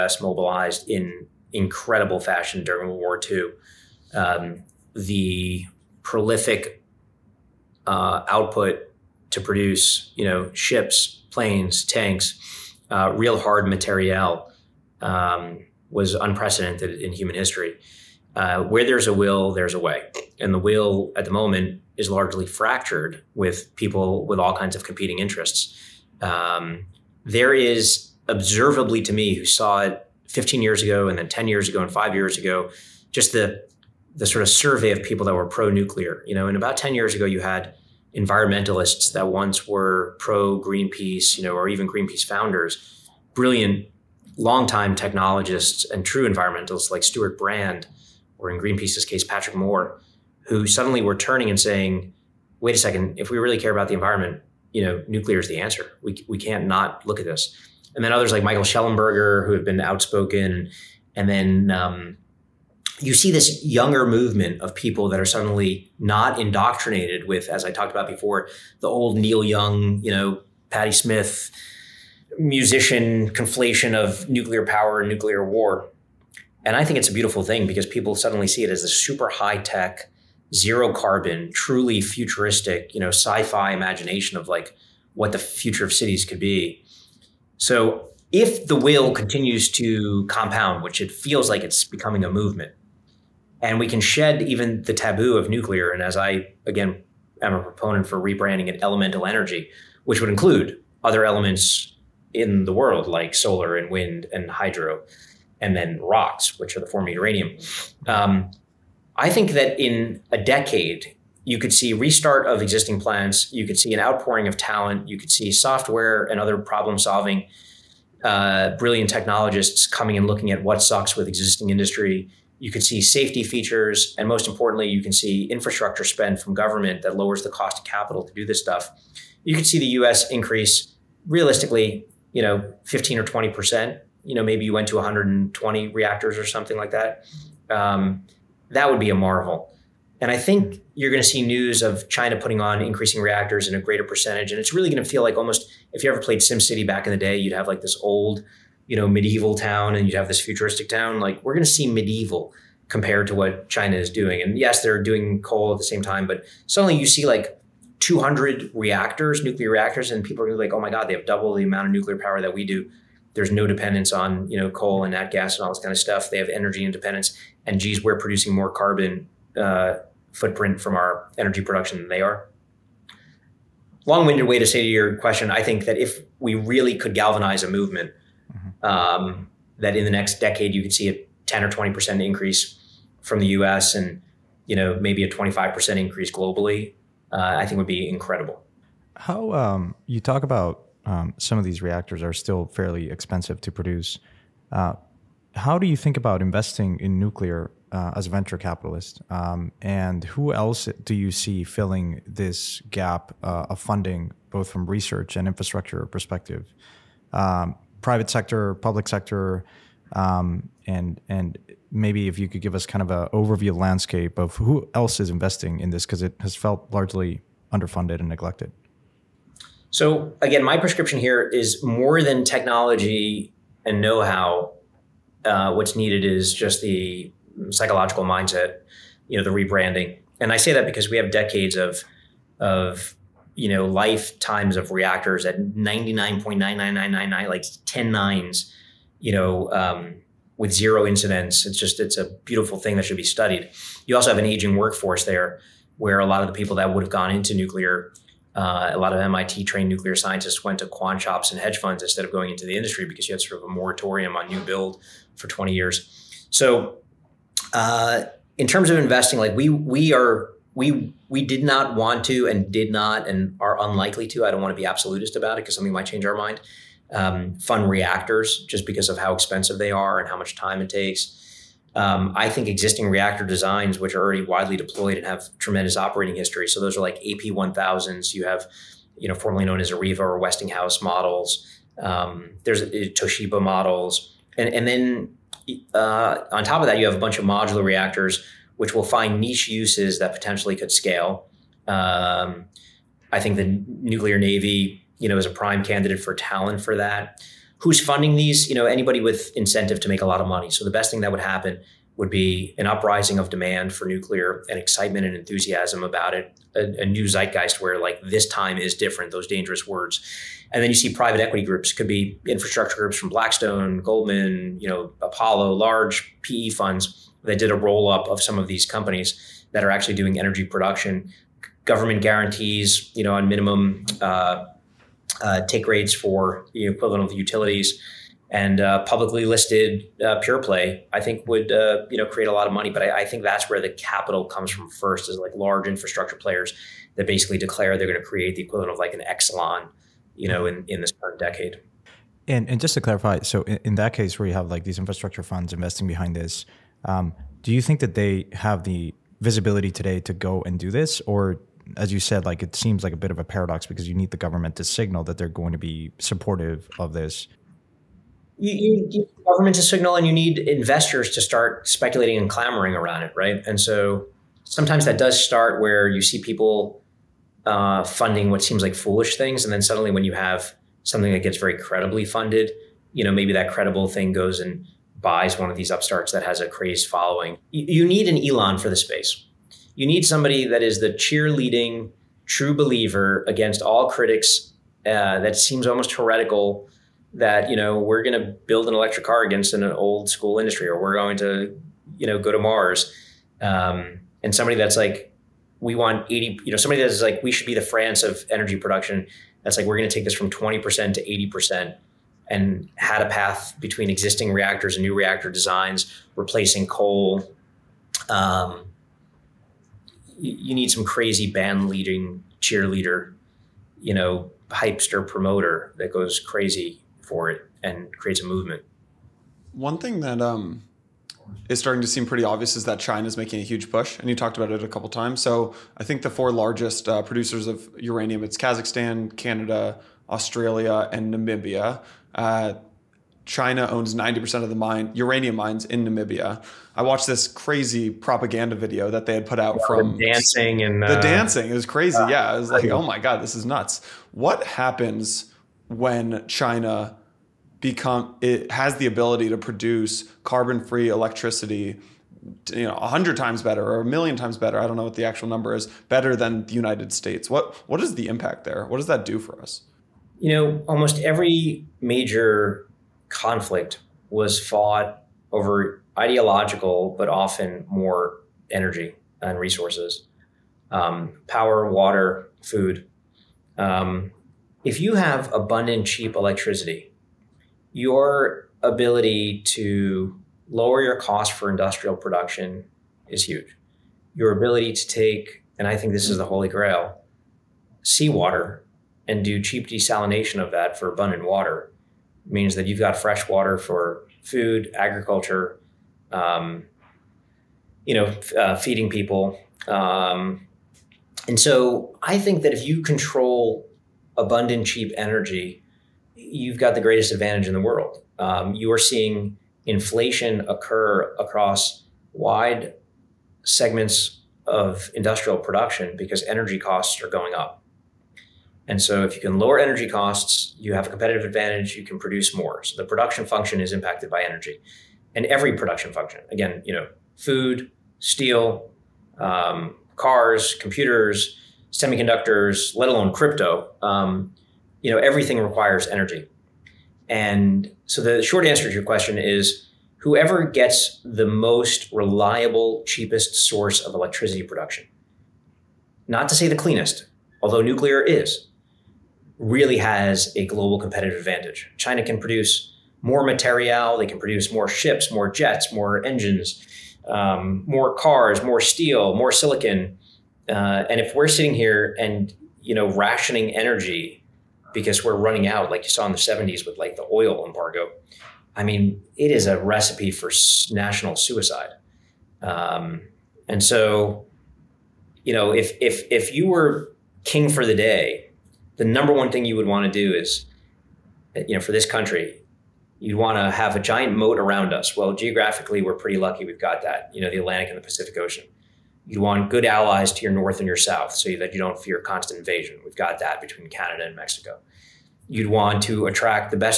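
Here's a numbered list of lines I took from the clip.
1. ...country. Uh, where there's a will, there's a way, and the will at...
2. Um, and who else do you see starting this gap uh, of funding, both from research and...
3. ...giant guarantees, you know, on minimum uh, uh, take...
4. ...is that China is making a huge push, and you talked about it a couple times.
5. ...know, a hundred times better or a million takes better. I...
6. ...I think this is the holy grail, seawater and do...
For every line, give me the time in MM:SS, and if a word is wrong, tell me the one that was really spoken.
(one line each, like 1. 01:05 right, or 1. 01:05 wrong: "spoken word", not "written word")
1. 00:17 wrong: "history", not "country"
2. 03:19 wrong: "filling", not "starting"
3. 05:21 wrong: "government", not "giant"
4. 07:02 right
5. 07:32 wrong: "times", not "takes"
6. 08:05 right.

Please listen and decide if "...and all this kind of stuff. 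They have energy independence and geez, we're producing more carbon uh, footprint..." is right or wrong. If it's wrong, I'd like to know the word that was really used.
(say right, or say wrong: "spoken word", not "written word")
right.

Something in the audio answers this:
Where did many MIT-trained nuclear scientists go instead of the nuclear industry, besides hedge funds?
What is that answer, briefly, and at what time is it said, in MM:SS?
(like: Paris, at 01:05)
quant shops, at 04:10.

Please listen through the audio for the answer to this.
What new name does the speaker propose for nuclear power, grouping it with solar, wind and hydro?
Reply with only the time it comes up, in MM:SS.
01:38.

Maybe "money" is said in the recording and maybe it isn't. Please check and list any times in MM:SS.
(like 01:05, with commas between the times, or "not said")
05:00, 05:32.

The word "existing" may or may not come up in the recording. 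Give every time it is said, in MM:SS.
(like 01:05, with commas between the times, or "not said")
01:52, 02:01, 04:32, 06:44.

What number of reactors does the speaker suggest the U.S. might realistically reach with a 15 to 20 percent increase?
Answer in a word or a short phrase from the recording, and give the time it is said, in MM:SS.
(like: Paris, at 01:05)
120, at 02:14.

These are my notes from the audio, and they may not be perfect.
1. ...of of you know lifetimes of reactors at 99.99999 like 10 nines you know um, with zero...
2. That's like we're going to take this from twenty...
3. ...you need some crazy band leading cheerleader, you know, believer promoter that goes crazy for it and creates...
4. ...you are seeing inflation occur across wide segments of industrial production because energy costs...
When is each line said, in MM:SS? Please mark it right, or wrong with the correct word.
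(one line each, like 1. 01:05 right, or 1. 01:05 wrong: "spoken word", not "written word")
1. 03:51 right
2. 06:39 right
3. 06:50 wrong: "hypester", not "believer"
4. 08:28 right.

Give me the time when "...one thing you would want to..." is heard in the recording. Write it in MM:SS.
09:39.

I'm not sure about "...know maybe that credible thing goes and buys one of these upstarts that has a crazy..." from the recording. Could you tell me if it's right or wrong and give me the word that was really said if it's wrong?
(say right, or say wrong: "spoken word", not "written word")
right.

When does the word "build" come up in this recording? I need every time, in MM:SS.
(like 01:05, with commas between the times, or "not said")
04:14, 06:28.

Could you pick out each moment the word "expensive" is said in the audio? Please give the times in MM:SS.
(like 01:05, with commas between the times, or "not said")
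03:13, 04:29.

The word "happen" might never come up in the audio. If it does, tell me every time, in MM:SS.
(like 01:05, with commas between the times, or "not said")
05:01, 07:24.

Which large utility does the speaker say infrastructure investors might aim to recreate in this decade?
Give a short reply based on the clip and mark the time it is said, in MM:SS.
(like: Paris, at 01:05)
Exelon, at 05:39.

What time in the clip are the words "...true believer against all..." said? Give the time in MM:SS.
06:22.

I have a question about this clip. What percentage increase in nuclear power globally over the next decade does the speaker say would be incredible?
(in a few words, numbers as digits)
25 percent.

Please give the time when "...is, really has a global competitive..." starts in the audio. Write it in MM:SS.
09:08.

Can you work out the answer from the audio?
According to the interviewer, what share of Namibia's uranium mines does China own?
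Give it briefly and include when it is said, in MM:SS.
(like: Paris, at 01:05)
90%, at 07:14.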